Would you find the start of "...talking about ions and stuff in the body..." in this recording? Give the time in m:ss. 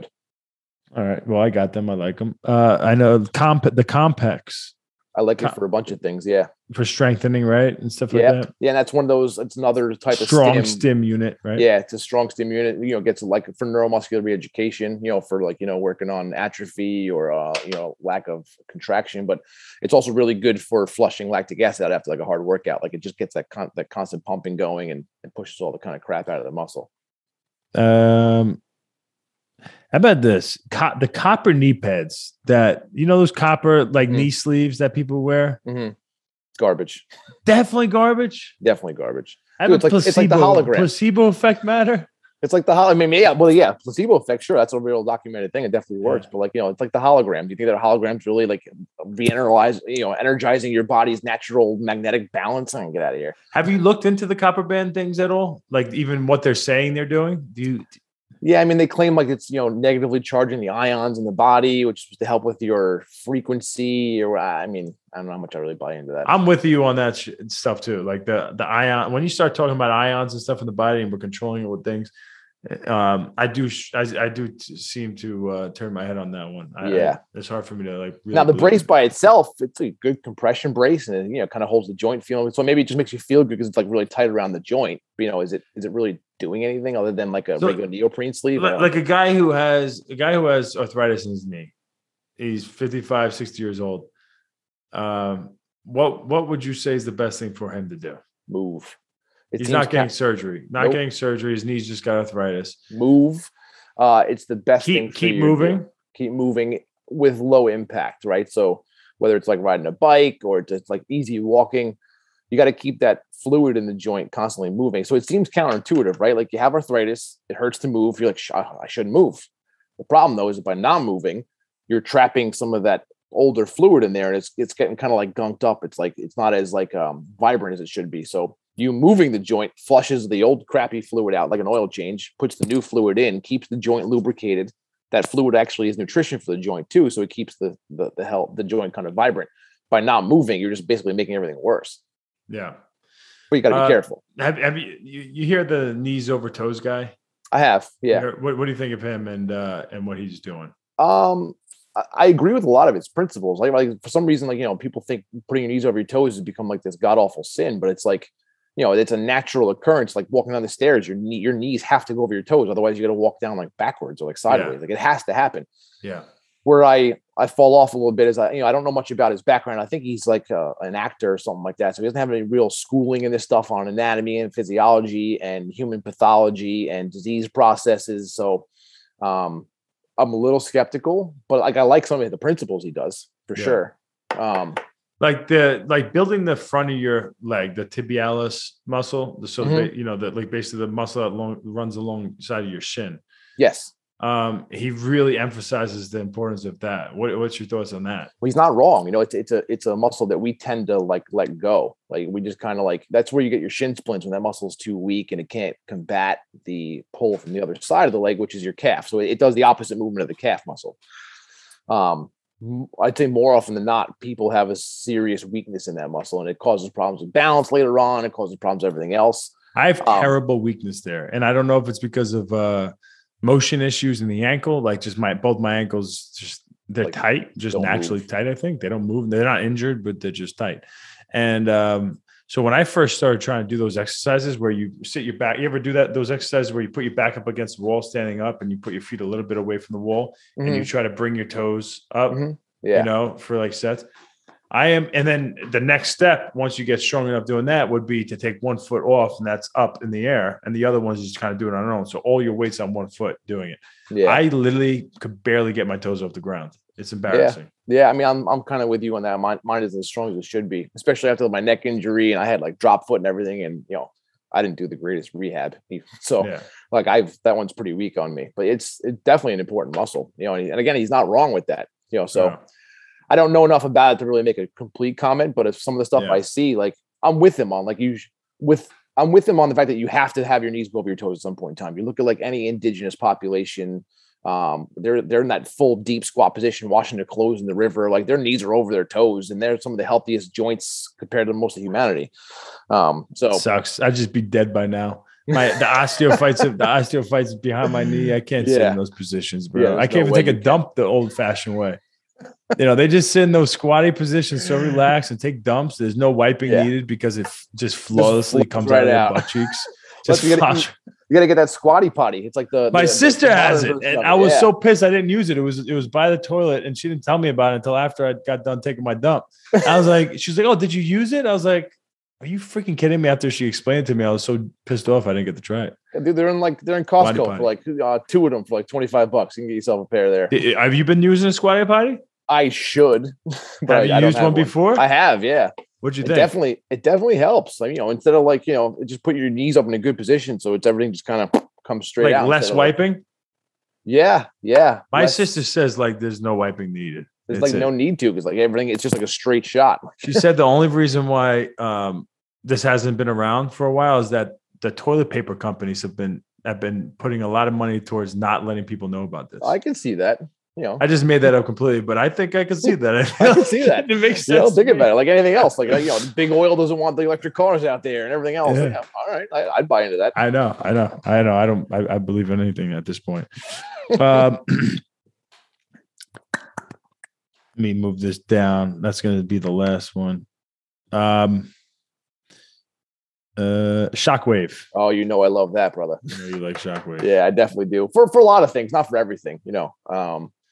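1:09.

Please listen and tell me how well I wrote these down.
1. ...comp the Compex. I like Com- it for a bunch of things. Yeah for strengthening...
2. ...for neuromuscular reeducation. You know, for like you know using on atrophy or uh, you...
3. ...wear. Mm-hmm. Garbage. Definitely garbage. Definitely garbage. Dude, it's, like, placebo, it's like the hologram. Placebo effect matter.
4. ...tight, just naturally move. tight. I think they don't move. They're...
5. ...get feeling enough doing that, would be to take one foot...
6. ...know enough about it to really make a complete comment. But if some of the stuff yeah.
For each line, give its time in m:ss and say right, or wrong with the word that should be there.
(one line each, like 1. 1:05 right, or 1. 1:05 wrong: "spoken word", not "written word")
1. 0:03 right
2. 0:13 wrong: "working", not "using"
3. 0:35 right
4. 3:47 right
5. 4:06 wrong: "strong", not "feeling"
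6. 4:33 right.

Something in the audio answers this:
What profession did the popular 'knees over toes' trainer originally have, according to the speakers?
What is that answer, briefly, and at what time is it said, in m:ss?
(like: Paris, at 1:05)
actor, at 2:50.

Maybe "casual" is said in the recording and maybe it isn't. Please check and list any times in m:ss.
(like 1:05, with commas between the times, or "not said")
not said.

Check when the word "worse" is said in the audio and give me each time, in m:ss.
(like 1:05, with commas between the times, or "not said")
2:21.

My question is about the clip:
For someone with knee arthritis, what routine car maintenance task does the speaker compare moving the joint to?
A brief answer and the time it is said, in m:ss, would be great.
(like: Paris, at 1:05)
an oil change, at 2:11.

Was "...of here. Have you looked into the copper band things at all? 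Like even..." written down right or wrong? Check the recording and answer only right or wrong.
right.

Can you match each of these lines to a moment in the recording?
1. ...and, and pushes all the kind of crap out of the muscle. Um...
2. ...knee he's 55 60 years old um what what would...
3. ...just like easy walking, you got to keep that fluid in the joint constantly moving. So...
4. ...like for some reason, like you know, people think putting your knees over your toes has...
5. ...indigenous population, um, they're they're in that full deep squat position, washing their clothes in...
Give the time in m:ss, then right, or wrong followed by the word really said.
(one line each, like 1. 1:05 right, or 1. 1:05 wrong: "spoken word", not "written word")
1. 0:24 right
2. 1:31 right
3. 1:50 right
4. 2:33 right
5. 4:42 right.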